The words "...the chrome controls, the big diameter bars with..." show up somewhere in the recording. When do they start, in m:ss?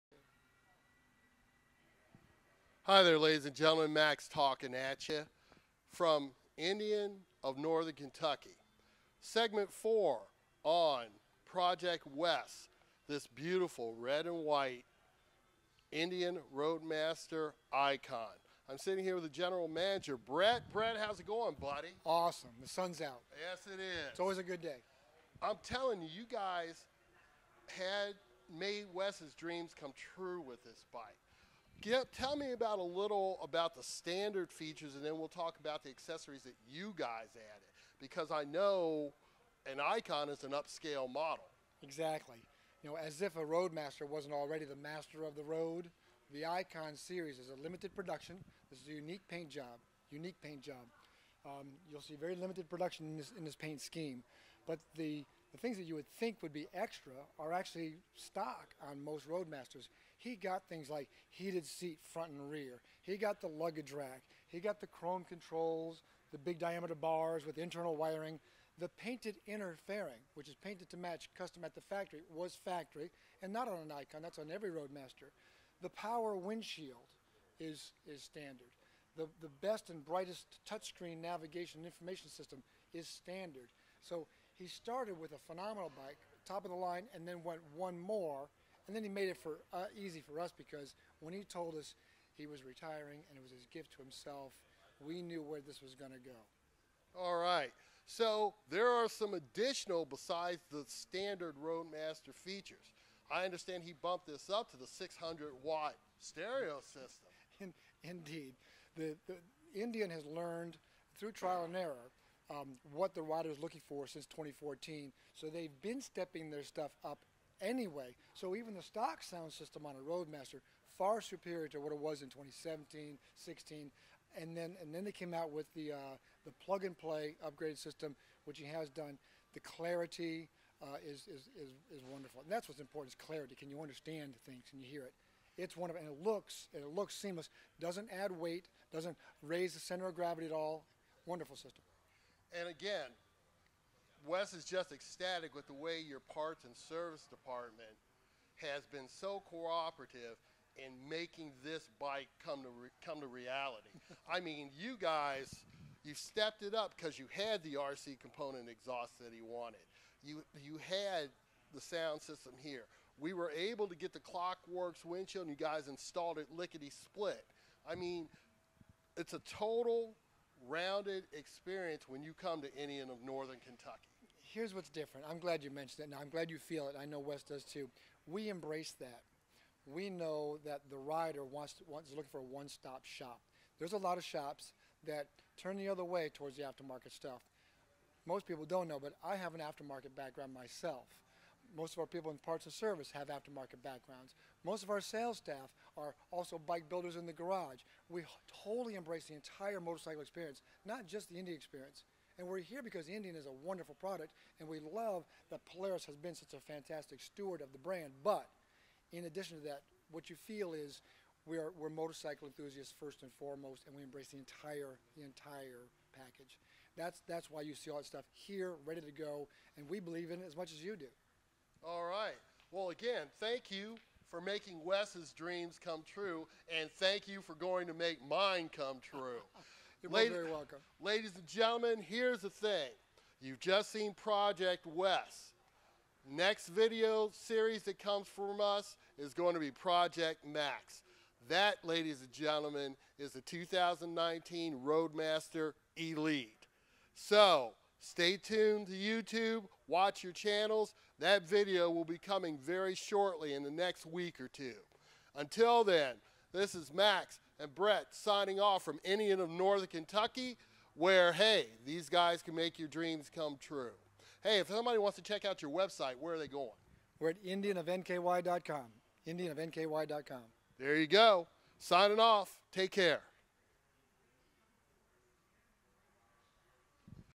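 1:04.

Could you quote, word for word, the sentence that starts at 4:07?
So, Stay tuned to YouTube, watch your channels.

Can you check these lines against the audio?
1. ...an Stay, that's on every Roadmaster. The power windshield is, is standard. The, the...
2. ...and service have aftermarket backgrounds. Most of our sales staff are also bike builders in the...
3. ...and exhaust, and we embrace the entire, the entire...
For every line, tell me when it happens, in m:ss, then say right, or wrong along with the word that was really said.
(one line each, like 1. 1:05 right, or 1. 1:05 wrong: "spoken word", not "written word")
1. 1:13 wrong: "Icon", not "Stay"
2. 3:12 right
3. 3:33 wrong: "foremost", not "exhaust".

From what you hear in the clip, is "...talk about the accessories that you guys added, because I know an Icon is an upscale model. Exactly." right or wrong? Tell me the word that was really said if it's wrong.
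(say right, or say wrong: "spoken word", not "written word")
right.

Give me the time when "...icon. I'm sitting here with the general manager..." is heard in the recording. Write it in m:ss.
0:17.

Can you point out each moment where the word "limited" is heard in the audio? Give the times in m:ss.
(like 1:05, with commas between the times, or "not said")
0:47, 0:52.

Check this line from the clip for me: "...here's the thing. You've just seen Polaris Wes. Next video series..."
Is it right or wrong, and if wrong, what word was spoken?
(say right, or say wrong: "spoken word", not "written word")
wrong: "Project", not "Polaris".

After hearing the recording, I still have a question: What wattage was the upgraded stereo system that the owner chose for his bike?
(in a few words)
600 watt.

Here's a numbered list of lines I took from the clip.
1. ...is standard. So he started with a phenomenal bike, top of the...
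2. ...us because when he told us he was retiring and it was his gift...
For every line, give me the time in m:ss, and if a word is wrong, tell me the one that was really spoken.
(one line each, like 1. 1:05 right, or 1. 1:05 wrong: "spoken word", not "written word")
1. 1:22 right
2. 1:30 right.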